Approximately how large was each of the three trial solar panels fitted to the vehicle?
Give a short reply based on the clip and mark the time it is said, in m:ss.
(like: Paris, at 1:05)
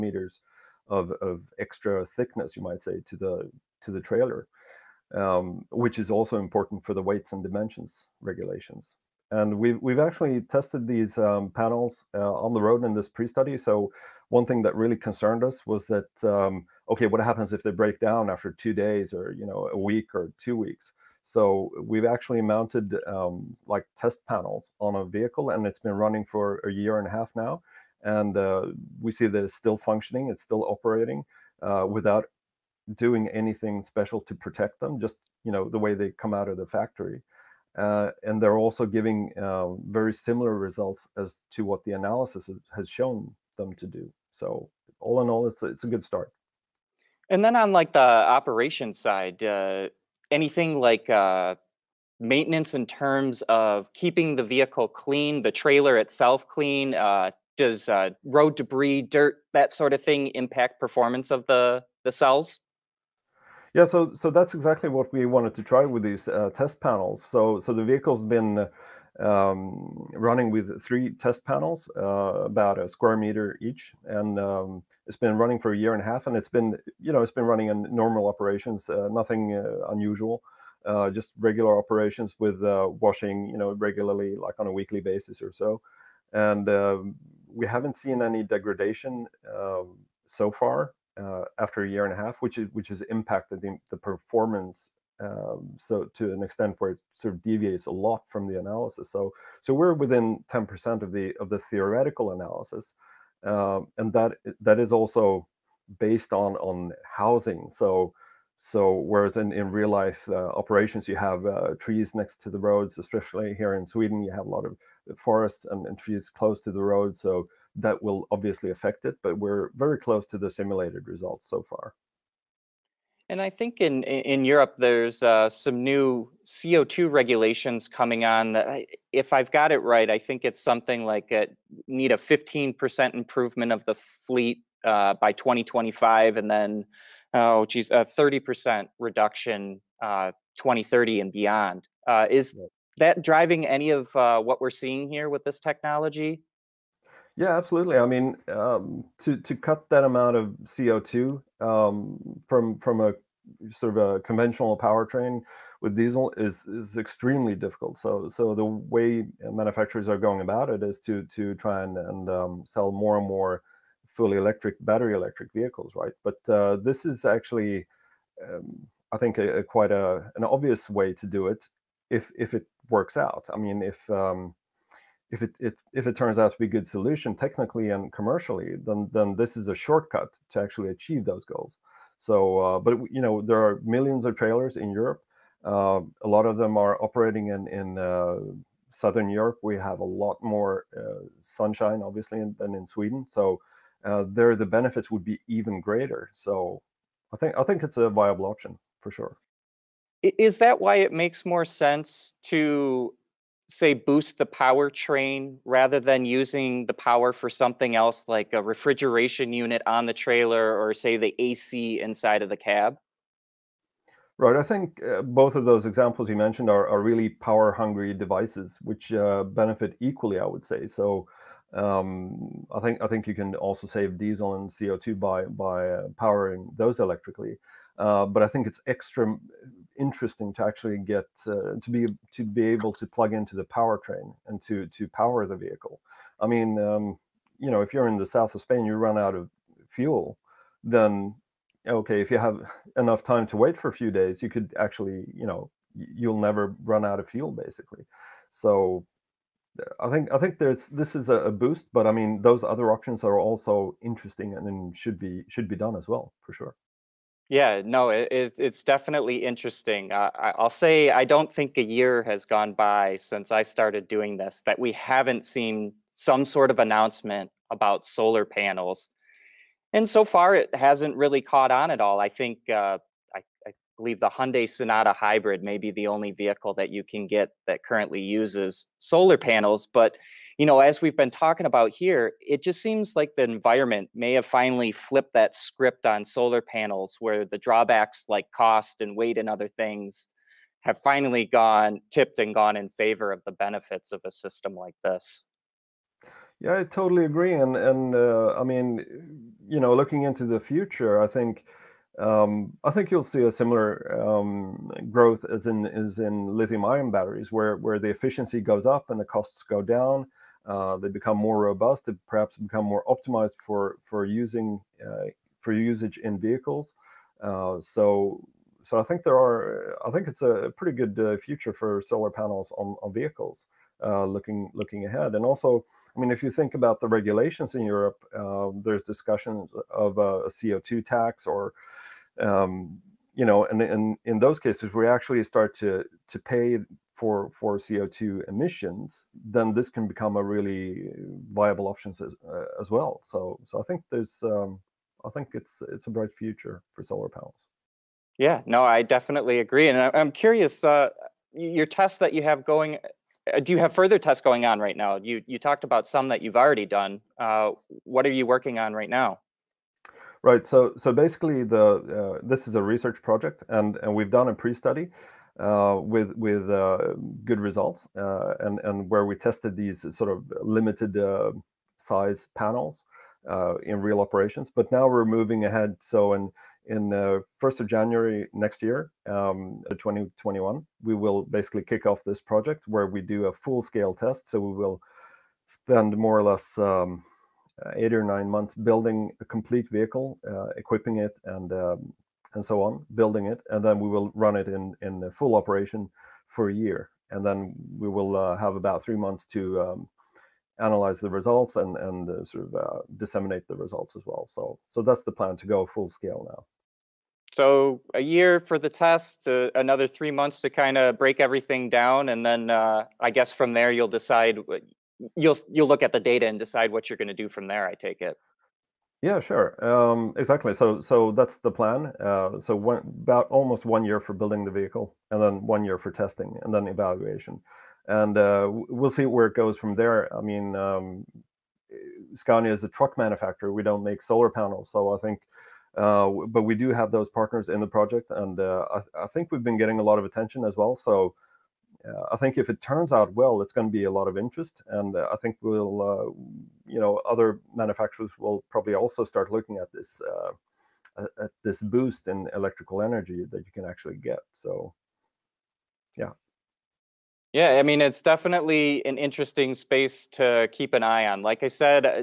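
1 square meter, at 1:12.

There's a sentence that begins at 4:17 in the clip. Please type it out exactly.
Yeah, no, it, it, it's definitely interesting.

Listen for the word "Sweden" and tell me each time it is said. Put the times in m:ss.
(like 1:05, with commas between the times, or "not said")
1:53, 3:12.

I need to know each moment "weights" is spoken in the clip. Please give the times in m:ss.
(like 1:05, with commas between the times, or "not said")
0:07, 4:49.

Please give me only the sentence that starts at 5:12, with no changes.
They perhaps become more optimized for for using uh, for usage in vehicles.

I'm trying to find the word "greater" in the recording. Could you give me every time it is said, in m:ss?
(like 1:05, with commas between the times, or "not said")
3:15.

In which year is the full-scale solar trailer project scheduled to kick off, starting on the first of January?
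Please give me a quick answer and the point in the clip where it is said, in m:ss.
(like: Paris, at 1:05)
2021, at 6:19.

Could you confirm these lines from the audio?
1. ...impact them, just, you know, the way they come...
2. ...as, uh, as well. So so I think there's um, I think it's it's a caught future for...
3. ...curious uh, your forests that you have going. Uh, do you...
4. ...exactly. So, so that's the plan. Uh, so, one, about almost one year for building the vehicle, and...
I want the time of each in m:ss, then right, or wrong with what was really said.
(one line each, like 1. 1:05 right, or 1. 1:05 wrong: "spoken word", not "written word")
1. 0:34 wrong: "protect", not "impact"
2. 5:42 wrong: "bright", not "caught"
3. 5:50 wrong: "tests", not "forests"
4. 7:00 right.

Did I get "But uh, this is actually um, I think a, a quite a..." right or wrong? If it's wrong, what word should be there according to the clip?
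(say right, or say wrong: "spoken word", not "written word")
right.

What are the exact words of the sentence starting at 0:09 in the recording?
And we've, we've actually tested these um, panels uh, on the road in this pre-study.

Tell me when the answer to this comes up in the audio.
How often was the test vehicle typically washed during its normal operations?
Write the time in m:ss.
1:24.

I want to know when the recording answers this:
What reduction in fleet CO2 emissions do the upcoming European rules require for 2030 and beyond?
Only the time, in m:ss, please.
2:18.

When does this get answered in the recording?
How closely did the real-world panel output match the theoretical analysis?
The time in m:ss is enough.
1:39.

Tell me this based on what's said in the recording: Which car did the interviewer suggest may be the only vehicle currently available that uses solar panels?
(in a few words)
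Hyundai Sonata Hybrid.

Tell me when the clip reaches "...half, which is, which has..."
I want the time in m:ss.
1:32.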